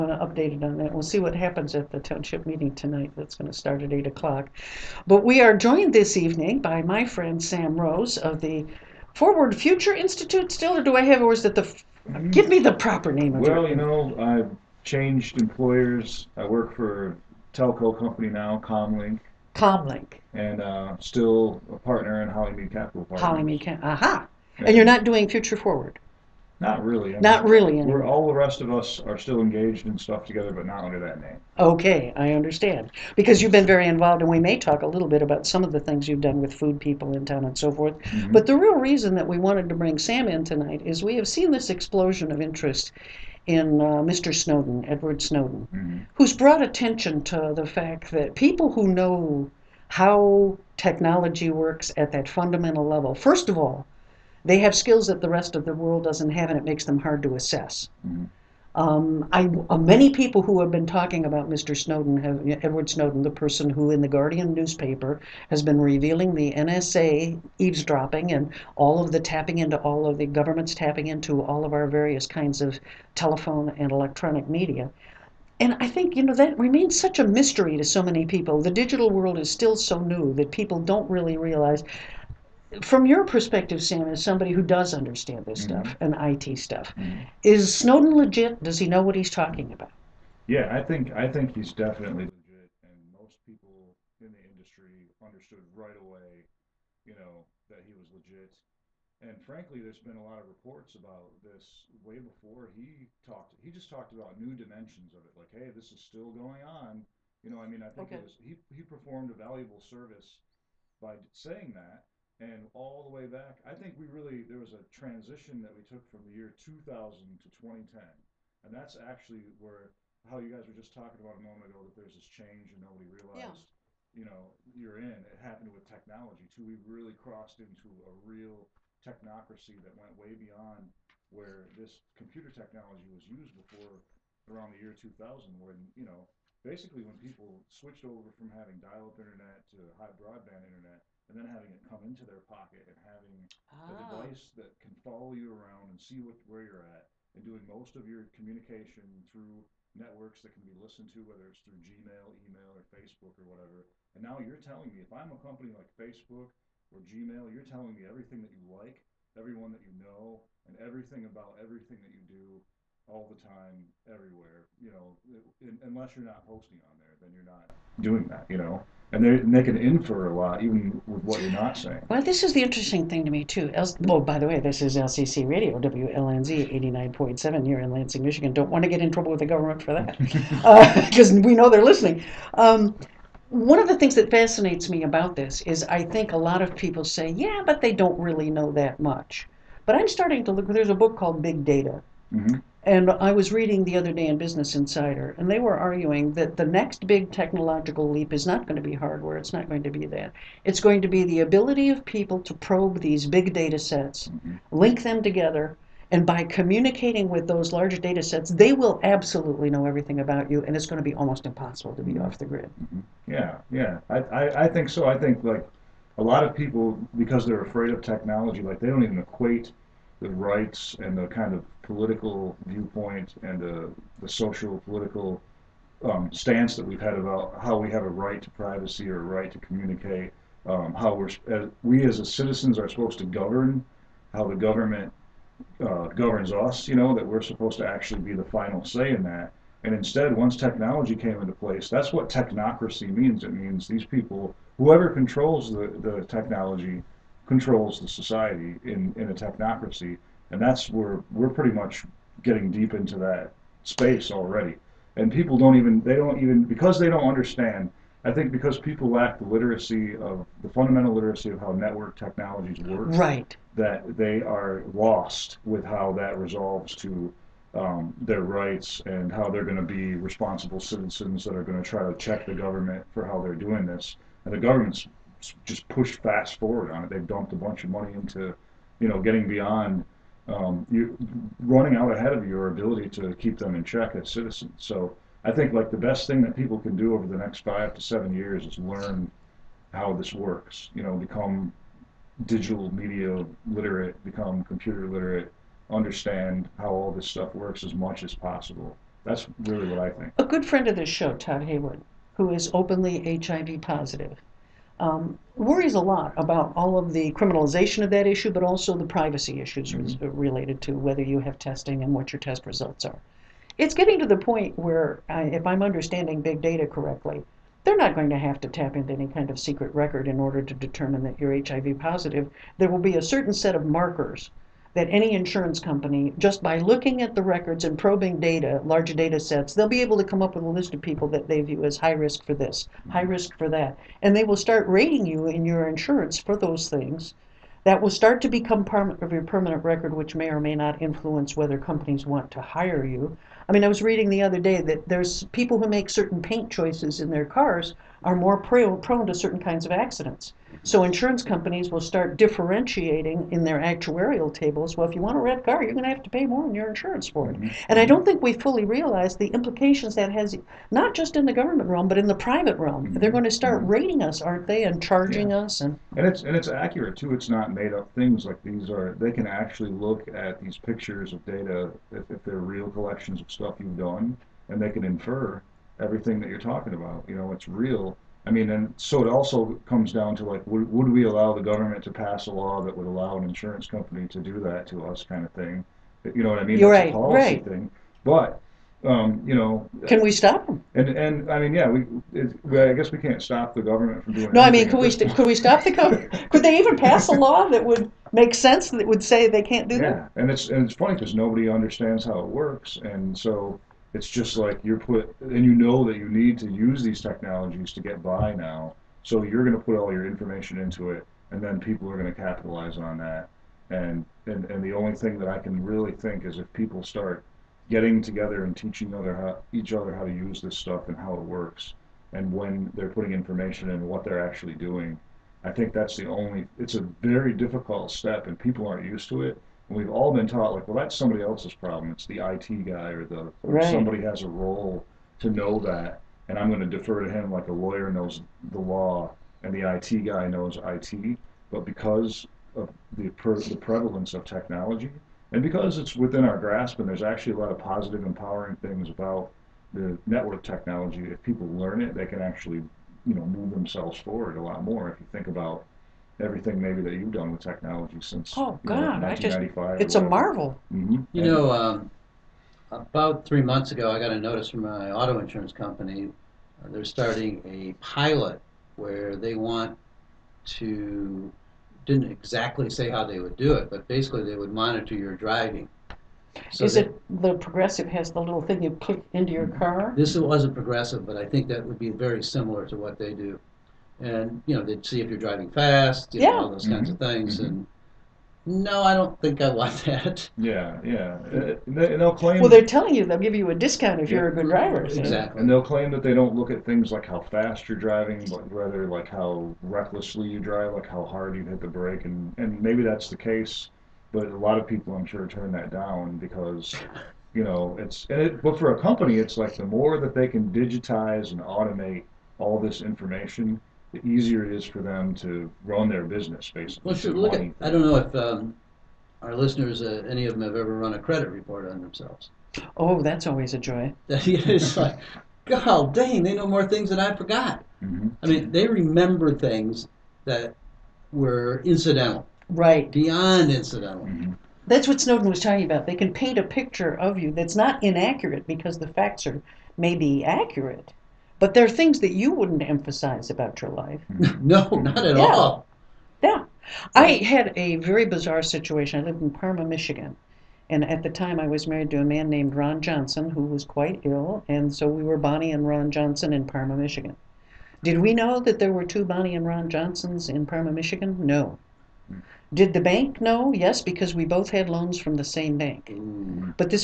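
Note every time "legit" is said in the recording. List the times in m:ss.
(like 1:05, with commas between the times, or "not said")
1:28, 1:32, 1:38.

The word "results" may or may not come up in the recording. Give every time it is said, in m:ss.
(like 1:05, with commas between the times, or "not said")
5:12.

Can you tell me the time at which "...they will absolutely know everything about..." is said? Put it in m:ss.
3:28.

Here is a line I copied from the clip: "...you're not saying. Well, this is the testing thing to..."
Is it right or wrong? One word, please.
wrong.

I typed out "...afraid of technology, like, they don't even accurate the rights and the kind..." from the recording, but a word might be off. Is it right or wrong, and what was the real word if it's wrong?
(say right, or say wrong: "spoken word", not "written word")
wrong: "equate", not "accurate".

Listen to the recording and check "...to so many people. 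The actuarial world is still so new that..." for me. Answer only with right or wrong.
wrong.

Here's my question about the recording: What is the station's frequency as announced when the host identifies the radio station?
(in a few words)
89.7.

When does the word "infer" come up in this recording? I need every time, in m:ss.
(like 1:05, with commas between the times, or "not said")
2:49, 6:15.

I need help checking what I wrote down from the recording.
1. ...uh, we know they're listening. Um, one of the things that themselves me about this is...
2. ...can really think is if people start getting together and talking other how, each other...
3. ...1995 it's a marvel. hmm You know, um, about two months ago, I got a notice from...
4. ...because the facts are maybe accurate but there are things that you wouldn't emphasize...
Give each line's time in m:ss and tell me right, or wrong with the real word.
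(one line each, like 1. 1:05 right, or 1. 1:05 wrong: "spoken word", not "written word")
1. 3:01 wrong: "fascinates", not "themselves"
2. 6:55 wrong: "teaching", not "talking"
3. 7:39 wrong: "three", not "two"
4. 8:58 right.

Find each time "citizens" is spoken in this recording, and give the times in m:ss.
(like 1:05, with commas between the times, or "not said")
3:52, 4:30, 4:44.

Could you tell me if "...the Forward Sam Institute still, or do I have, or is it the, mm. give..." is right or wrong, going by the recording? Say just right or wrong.
wrong.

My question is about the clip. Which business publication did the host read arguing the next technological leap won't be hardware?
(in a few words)
Business Insider.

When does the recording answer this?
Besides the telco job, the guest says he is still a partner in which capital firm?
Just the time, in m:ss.
0:22.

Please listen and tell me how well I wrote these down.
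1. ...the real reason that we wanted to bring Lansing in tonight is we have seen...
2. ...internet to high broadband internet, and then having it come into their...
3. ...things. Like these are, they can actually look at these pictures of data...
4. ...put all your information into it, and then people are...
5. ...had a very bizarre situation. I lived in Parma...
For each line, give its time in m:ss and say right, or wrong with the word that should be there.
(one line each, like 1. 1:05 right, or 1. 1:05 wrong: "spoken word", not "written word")
1. 0:38 wrong: "Sam", not "Lansing"
2. 2:19 right
3. 6:08 right
4. 6:49 right
5. 9:07 right.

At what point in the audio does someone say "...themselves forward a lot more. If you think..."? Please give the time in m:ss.
7:33.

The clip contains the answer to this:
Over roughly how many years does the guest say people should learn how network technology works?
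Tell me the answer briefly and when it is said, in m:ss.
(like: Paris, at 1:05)
5 to 7 years, at 4:47.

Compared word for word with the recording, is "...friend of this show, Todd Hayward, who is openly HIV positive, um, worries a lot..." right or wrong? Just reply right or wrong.
right.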